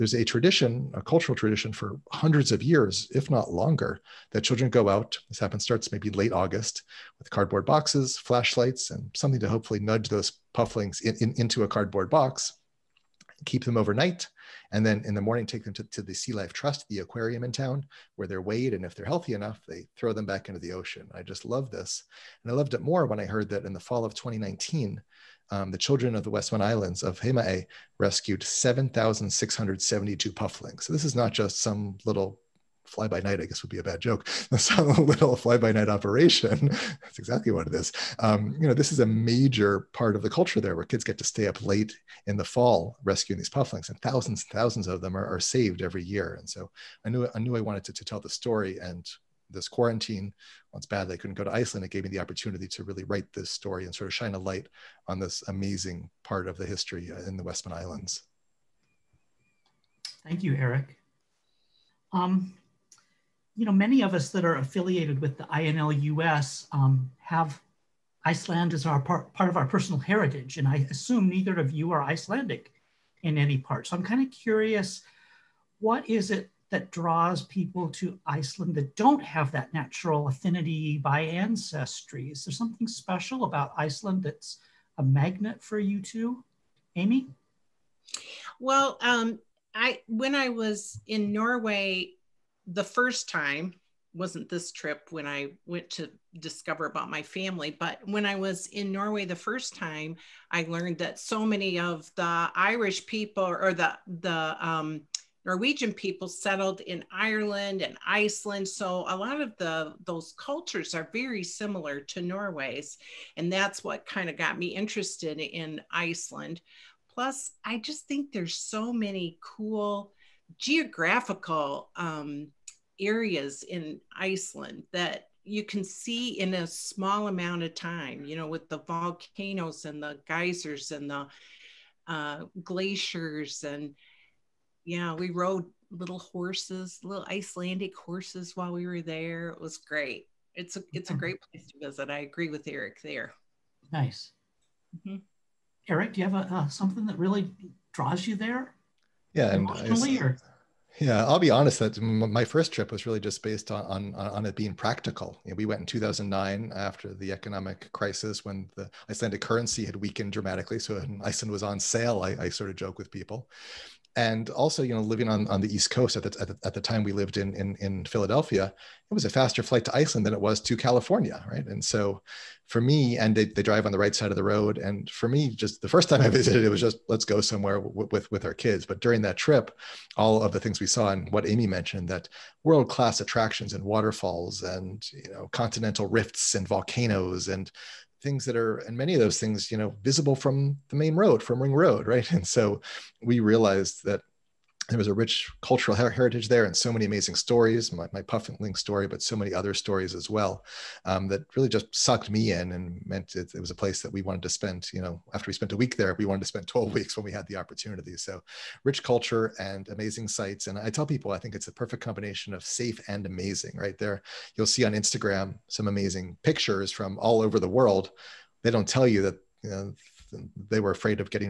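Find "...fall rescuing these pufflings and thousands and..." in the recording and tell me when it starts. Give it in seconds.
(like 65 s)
42 s.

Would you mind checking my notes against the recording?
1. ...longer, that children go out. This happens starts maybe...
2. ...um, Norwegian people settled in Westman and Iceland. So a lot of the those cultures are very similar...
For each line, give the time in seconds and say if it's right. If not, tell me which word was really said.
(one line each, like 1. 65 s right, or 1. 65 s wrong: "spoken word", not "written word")
1. 3 s right
2. 104 s wrong: "Ireland", not "Westman".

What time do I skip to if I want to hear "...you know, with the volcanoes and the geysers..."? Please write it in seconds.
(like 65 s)
128 s.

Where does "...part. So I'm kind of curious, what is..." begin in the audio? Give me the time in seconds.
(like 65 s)
73 s.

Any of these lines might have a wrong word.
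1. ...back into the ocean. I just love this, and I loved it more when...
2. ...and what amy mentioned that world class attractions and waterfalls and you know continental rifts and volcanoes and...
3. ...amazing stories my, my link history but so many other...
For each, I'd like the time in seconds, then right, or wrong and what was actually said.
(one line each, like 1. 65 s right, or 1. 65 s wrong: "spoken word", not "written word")
1. 20 s right
2. 181 s right
3. 197 s wrong: "story", not "history".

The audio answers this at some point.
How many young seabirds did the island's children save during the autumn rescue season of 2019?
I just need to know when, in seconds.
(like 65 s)
28 s.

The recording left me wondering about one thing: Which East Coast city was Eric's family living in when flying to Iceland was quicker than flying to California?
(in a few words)
Philadelphia.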